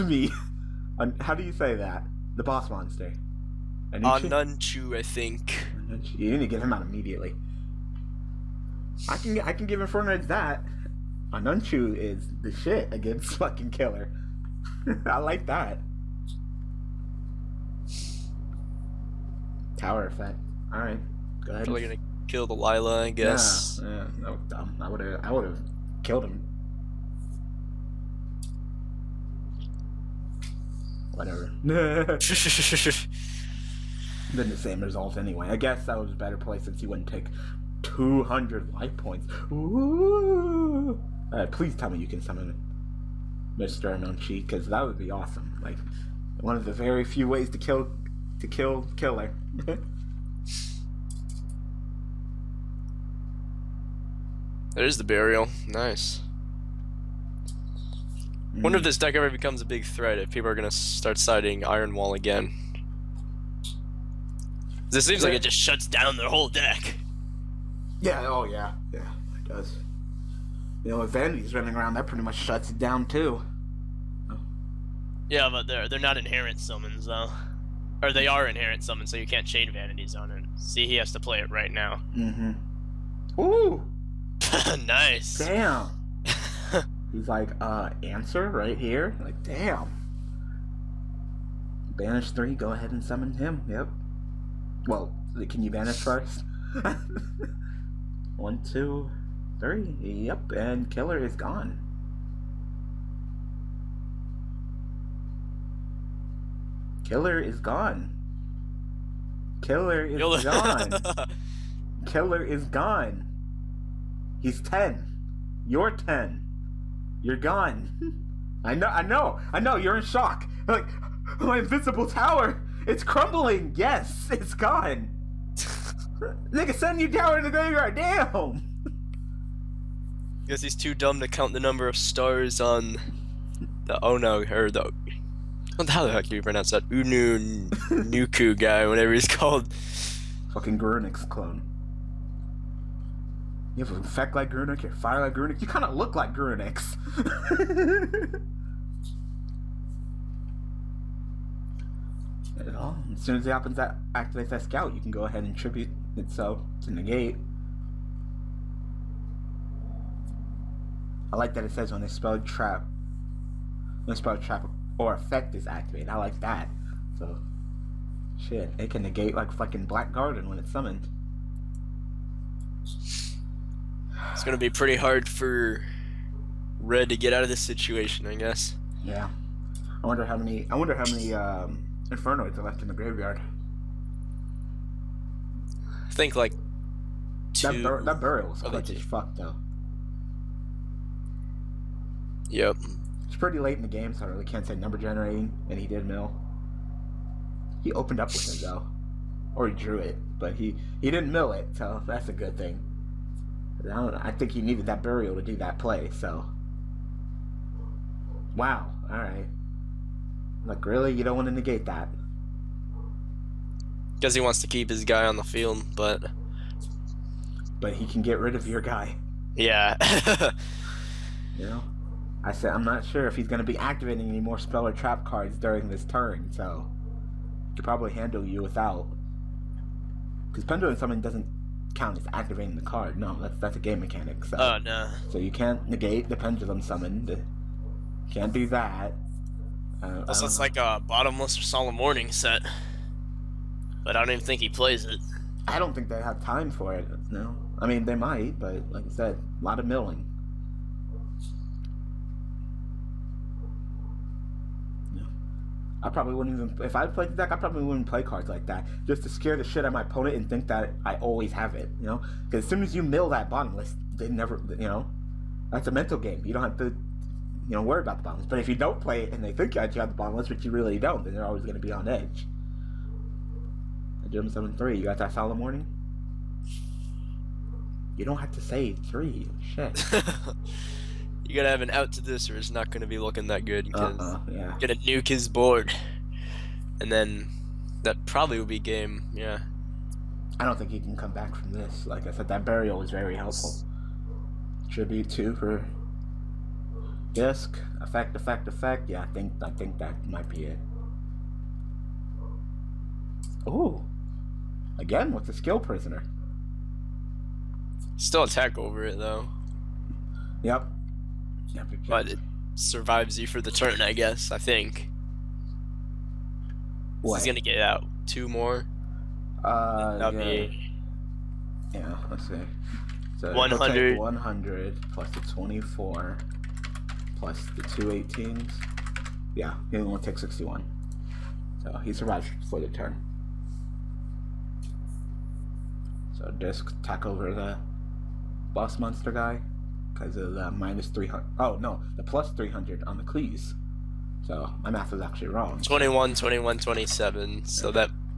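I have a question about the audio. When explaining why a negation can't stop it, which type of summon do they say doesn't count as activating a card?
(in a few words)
Pendulum Summon.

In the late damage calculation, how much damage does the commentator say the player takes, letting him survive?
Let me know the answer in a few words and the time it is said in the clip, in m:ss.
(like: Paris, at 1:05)
61, at 5:30.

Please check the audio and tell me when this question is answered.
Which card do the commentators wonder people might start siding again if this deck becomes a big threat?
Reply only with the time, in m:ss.
1:01.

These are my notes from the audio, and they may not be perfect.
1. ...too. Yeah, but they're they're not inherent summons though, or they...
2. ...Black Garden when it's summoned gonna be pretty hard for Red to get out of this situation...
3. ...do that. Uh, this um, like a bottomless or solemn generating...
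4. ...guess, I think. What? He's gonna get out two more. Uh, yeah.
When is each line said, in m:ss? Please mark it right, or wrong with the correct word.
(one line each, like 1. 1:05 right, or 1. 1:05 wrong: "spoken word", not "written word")
1. 1:13 right
2. 2:49 right
3. 3:58 wrong: "warning", not "generating"
4. 5:14 right.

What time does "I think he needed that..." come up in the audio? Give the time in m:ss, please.
3:24.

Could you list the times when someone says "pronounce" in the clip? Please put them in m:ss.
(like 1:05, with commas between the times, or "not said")
2:16.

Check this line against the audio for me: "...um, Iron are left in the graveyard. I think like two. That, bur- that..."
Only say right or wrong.
wrong.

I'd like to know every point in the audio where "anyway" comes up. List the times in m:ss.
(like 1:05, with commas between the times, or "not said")
0:35.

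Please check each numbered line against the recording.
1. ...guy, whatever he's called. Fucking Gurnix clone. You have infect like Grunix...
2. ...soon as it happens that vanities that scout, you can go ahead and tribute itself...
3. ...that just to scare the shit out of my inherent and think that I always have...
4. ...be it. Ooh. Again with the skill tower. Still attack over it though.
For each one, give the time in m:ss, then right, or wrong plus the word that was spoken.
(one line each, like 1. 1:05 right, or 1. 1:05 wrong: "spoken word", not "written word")
1. 2:18 right
2. 2:33 wrong: "activates", not "vanities"
3. 4:18 wrong: "opponent", not "inherent"
4. 5:00 wrong: "prisoner", not "tower".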